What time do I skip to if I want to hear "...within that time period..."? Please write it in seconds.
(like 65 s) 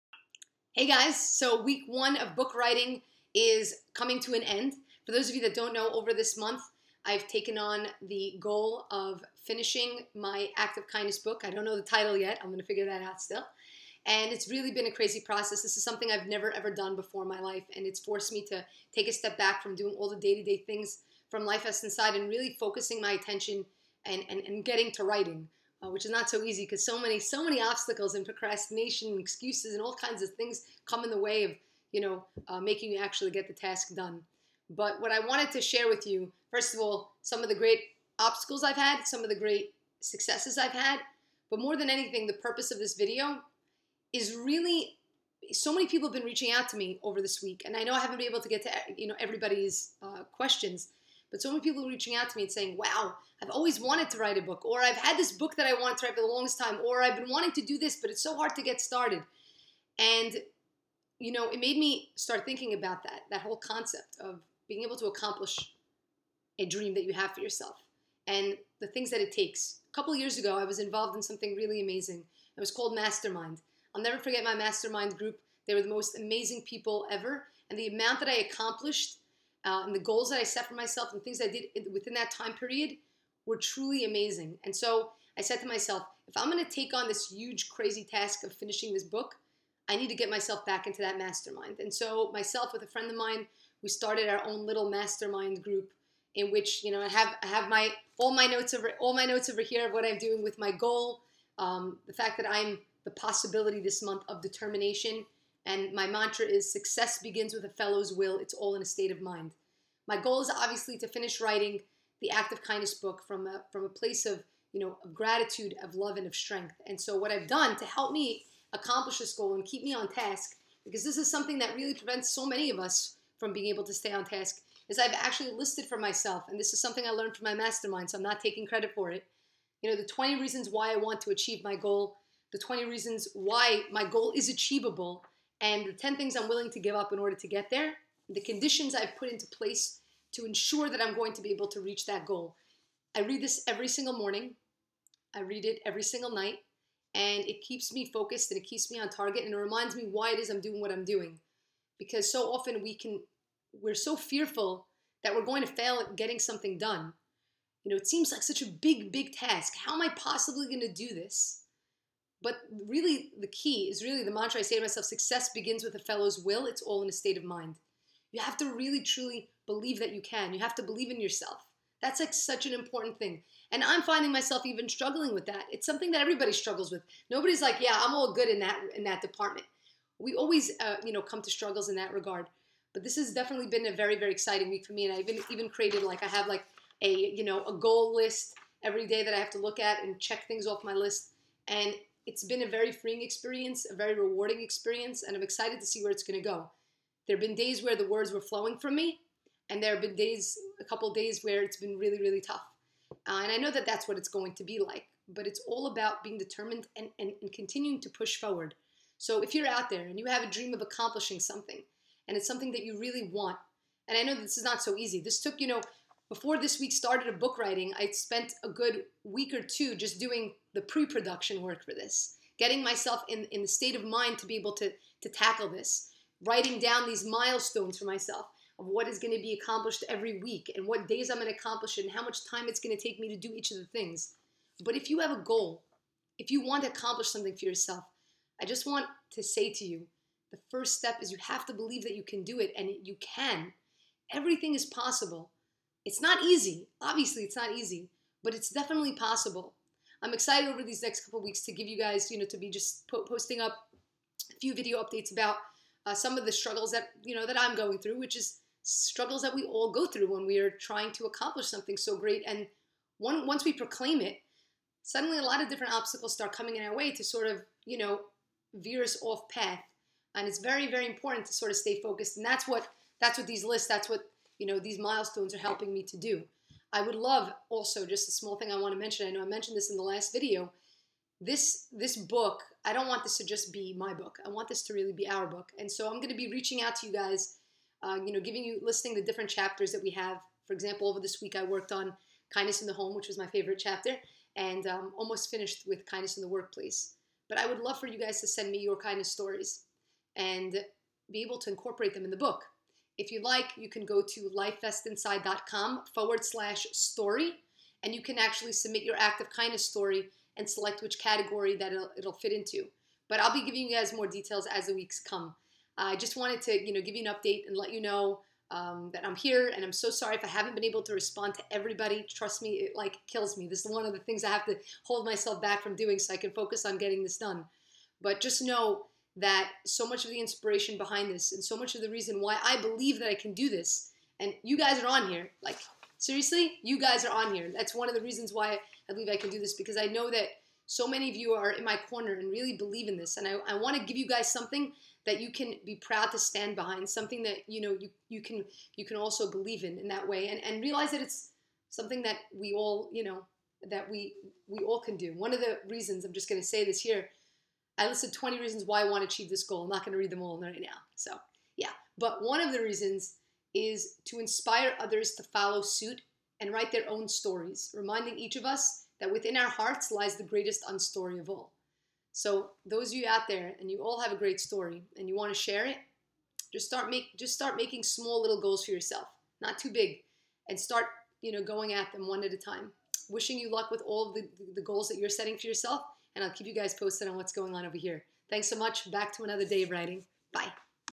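81 s.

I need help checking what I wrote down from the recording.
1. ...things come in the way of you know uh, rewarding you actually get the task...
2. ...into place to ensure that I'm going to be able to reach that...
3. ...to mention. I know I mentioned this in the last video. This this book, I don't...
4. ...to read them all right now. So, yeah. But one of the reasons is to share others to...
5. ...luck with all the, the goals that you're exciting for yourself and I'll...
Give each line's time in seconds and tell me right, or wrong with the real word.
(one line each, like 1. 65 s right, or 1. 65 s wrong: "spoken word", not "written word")
1. 30 s wrong: "making", not "rewarding"
2. 139 s right
3. 278 s right
4. 360 s wrong: "inspire", not "share"
5. 383 s wrong: "setting", not "exciting".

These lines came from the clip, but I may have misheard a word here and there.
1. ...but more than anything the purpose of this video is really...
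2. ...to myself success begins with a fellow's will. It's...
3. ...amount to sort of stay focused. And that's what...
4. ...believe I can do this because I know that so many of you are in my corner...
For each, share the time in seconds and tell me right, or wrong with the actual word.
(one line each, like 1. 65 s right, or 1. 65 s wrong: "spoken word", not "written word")
1. 41 s right
2. 164 s right
3. 271 s wrong: "important", not "amount"
4. 339 s right.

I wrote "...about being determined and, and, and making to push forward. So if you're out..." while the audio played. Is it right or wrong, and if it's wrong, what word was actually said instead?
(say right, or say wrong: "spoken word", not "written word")
wrong: "continuing", not "making".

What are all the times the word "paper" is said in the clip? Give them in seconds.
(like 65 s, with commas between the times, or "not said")
not said.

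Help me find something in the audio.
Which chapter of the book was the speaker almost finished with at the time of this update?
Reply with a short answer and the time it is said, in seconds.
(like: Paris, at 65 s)
Kindness in the workplace, at 296 s.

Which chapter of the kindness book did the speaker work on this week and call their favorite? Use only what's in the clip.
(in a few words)
Kindness in the home.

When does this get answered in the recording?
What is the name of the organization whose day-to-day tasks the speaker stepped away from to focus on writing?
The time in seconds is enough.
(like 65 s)
21 s.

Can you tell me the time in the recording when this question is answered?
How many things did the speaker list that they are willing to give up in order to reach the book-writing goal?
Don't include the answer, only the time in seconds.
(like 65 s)
135 s.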